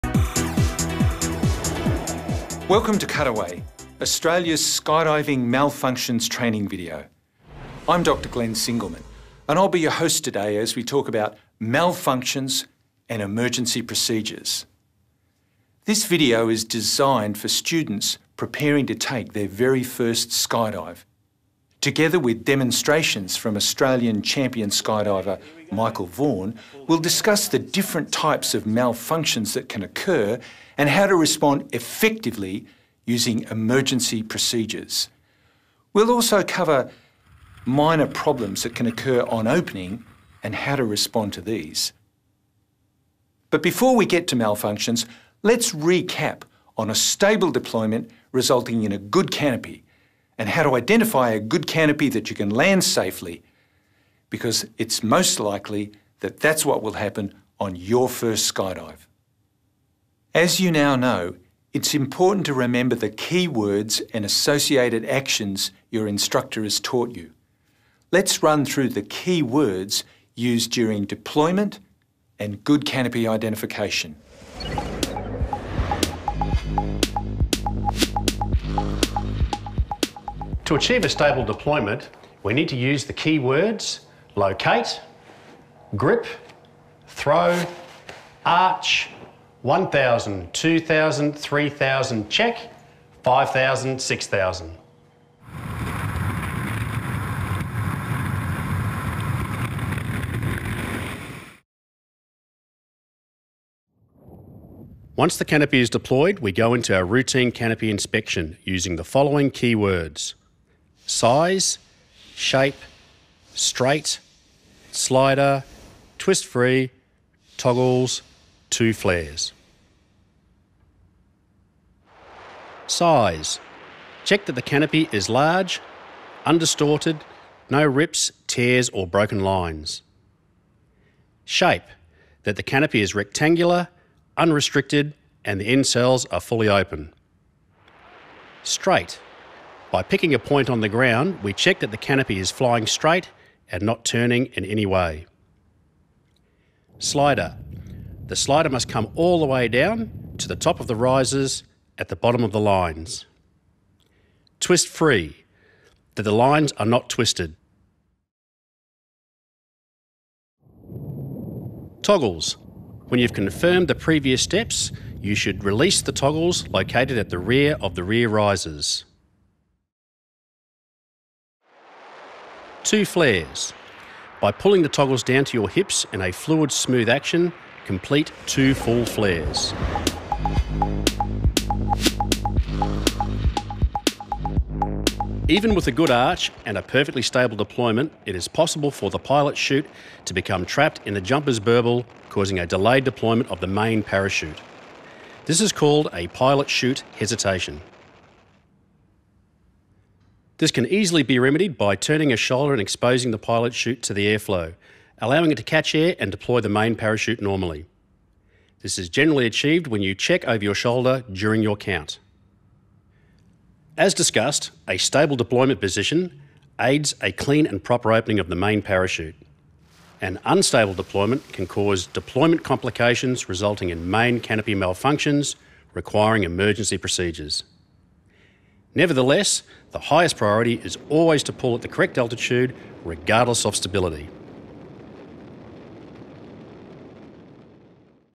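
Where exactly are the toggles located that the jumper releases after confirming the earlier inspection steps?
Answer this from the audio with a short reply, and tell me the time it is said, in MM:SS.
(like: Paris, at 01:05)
rear of the rear risers, at 02:47.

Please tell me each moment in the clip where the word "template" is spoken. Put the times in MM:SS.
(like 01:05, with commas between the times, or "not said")
not said.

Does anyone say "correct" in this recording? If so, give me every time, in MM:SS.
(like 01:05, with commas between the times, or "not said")
03:51.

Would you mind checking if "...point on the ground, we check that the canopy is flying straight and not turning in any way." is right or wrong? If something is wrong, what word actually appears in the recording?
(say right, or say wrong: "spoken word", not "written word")
right.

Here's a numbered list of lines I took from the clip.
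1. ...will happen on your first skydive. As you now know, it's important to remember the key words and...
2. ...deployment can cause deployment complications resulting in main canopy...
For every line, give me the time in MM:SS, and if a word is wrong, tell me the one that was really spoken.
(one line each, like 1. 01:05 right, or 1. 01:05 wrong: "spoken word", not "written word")
1. 00:56 right
2. 03:40 right.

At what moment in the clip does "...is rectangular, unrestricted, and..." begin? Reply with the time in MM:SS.
02:13.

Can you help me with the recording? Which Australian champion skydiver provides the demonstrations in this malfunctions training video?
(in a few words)
Michael Vaughan.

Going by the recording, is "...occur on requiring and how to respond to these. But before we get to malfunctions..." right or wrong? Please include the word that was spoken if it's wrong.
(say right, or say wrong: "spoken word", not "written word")
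wrong: "opening", not "requiring".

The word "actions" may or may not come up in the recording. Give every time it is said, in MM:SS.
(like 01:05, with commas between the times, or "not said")
01:05, 02:57.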